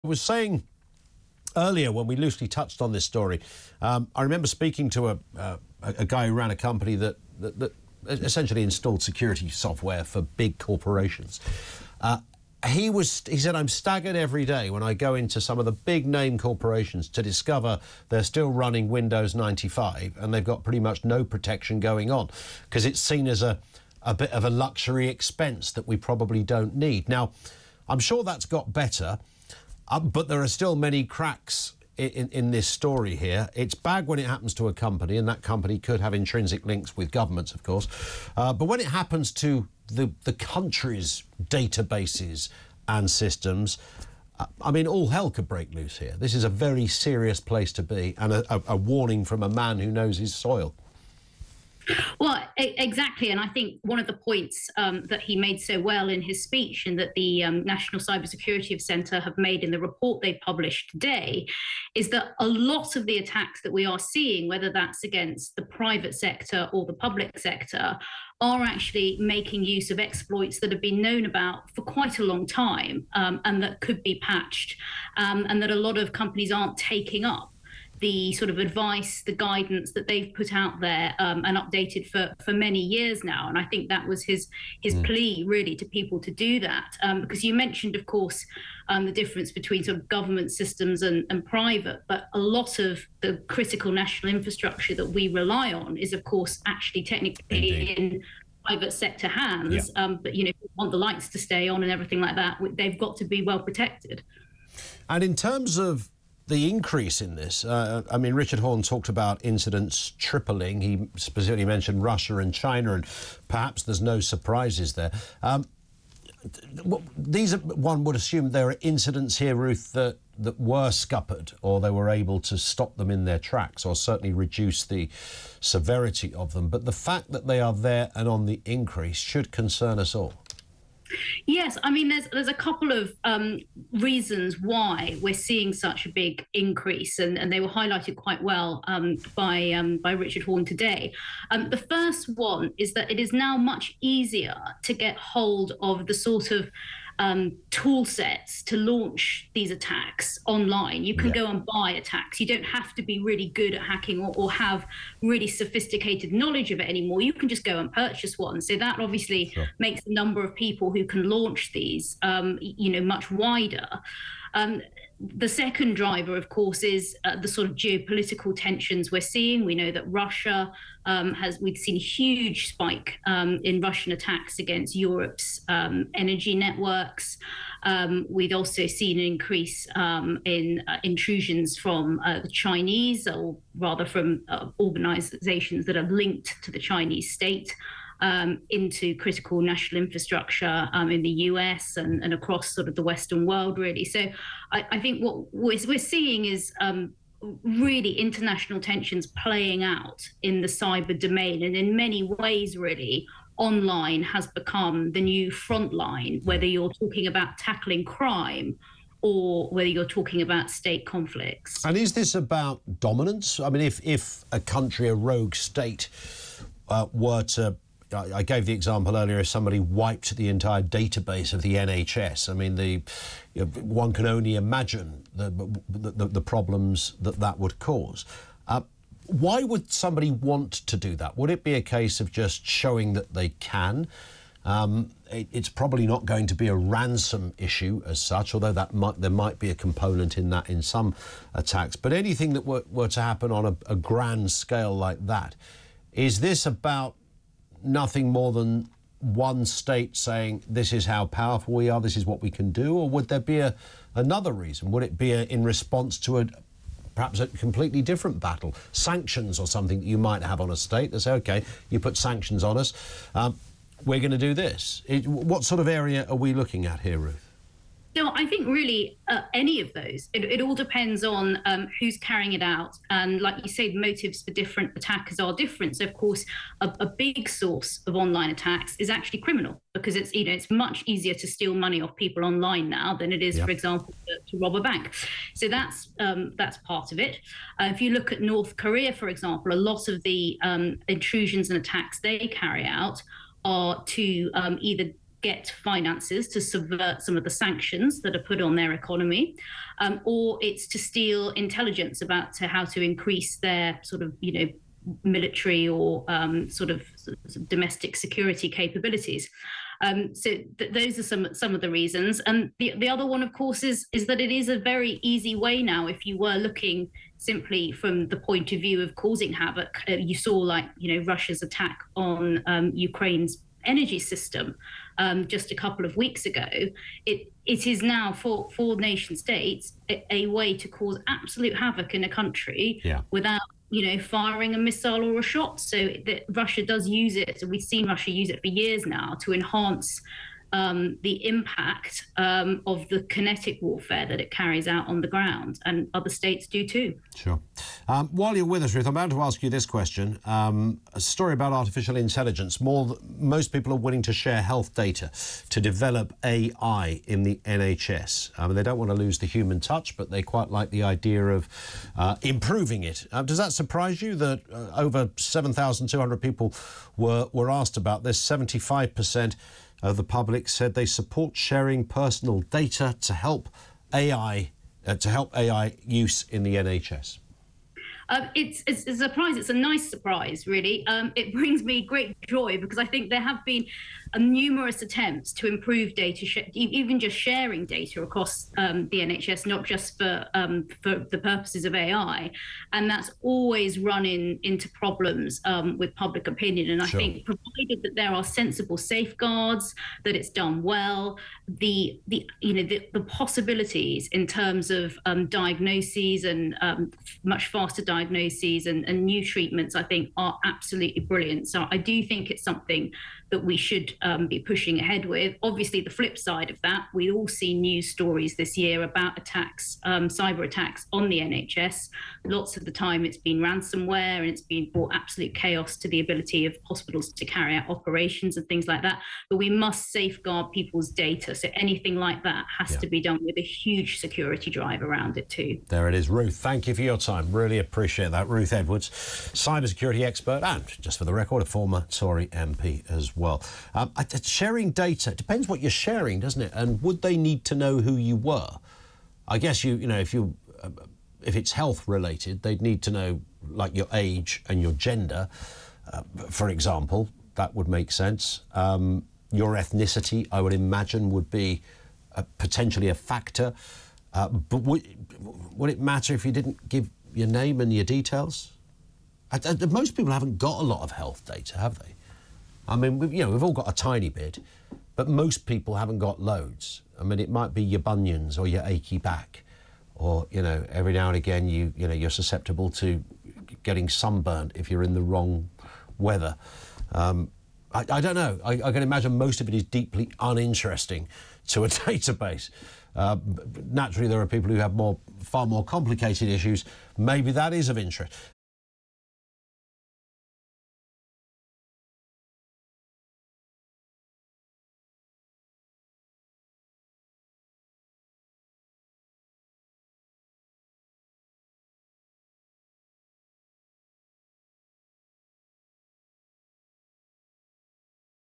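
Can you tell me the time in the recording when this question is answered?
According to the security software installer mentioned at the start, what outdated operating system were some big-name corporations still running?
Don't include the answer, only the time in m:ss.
0:18.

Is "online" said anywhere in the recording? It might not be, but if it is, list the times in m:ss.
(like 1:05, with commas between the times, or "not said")
2:30, 3:23, 4:38, 4:42.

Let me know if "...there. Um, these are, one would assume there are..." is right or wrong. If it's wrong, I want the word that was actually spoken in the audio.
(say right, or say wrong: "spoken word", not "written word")
right.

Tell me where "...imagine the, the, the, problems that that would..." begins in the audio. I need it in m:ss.
3:44.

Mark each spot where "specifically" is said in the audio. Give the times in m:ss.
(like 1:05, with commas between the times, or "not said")
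1:51.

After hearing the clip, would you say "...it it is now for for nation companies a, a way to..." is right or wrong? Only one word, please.
wrong.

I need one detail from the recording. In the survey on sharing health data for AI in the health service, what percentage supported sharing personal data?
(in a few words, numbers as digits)
75 percent.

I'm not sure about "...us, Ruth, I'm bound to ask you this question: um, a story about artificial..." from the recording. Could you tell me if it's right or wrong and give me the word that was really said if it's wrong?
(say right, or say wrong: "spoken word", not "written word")
right.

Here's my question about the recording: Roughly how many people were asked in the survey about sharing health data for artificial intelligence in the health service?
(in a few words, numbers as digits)
7,200.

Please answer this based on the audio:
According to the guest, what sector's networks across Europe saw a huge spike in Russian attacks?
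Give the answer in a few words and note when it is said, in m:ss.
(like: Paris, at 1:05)
energy networks, at 2:56.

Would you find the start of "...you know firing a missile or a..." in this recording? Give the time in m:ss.
5:33.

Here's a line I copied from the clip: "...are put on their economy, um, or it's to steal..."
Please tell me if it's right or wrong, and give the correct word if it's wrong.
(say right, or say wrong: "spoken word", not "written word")
right.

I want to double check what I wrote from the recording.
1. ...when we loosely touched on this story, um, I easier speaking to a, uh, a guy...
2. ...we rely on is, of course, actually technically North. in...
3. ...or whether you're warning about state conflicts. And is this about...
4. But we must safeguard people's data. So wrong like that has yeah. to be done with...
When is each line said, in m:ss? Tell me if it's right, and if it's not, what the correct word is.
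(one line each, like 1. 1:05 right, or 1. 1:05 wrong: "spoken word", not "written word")
1. 0:01 wrong: "remember", not "easier"
2. 1:35 wrong: "Indeed", not "North"
3. 3:29 wrong: "talking", not "warning"
4. 7:09 wrong: "anything", not "wrong".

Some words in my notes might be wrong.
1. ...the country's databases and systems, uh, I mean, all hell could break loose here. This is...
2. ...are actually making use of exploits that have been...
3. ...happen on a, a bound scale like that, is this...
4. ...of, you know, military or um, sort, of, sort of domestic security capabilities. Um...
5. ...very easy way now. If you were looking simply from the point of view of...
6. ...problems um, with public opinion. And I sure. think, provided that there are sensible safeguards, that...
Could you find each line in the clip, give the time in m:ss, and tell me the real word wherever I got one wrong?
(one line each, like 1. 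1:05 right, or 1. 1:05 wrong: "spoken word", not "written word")
1. 0:40 right
2. 1:08 right
3. 4:03 wrong: "grand", not "bound"
4. 5:04 right
5. 5:14 right
6. 6:34 right.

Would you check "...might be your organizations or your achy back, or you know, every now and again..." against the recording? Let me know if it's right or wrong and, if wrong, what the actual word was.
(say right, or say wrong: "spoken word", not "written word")
wrong: "bunions", not "organizations".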